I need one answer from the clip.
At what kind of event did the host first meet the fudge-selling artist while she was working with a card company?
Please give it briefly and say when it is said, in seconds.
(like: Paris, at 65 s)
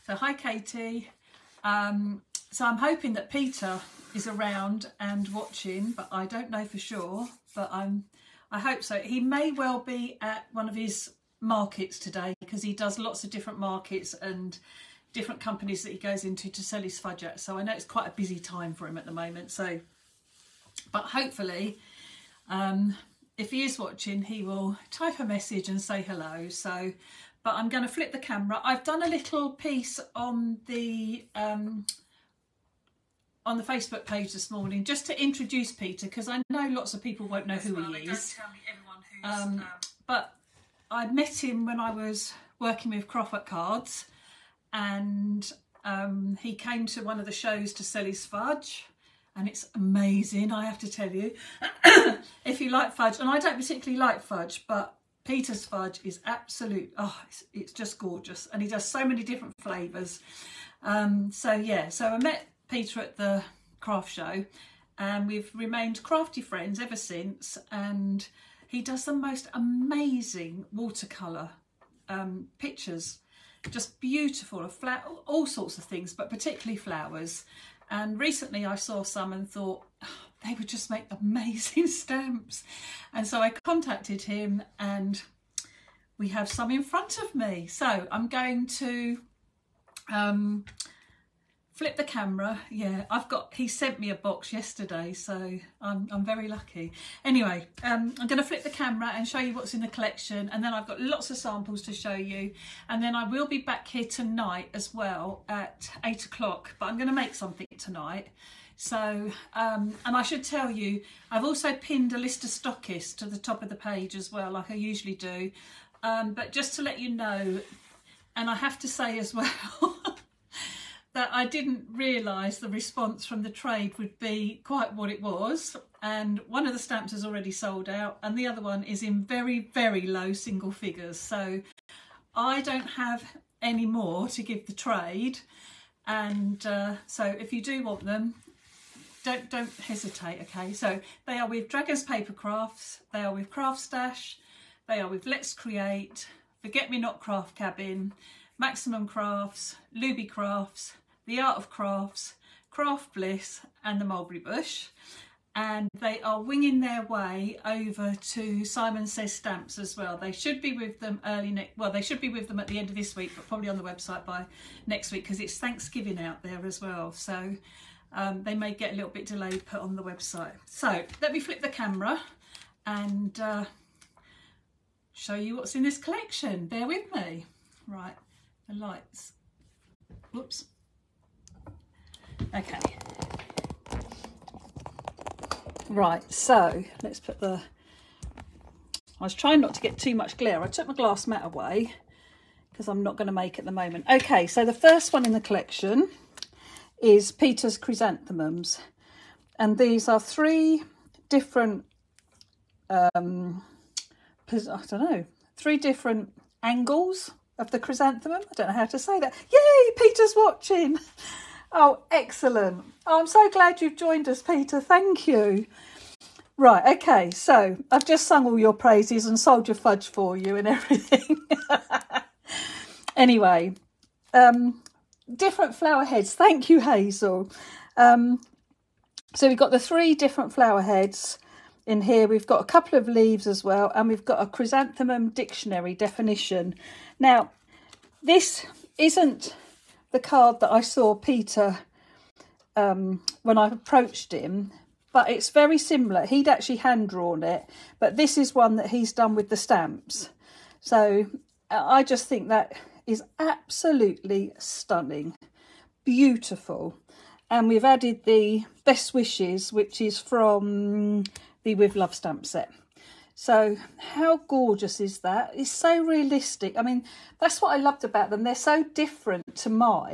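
craft show, at 63 s.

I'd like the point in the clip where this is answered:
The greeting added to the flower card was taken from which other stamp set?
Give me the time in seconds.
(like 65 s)
261 s.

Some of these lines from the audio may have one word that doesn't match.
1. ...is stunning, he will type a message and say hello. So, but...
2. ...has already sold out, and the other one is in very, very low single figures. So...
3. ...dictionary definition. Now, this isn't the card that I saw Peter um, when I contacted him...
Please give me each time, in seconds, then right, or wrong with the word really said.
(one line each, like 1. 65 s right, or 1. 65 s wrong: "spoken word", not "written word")
1. 23 s wrong: "watching", not "stunning"
2. 127 s right
3. 235 s wrong: "approached", not "contacted".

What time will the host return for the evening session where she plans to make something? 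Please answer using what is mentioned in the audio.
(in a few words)
8 o'clock.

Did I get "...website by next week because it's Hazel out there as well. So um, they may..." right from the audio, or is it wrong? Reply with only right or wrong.
wrong.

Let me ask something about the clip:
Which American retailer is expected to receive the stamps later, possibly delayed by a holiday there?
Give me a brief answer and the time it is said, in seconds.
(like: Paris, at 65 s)
Simon Says Stamps, at 158 s.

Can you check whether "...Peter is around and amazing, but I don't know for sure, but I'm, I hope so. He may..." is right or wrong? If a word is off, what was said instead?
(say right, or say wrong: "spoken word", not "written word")
wrong: "watching", not "amazing".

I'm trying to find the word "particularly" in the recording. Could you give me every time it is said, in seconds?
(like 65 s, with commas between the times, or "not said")
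53 s, 76 s.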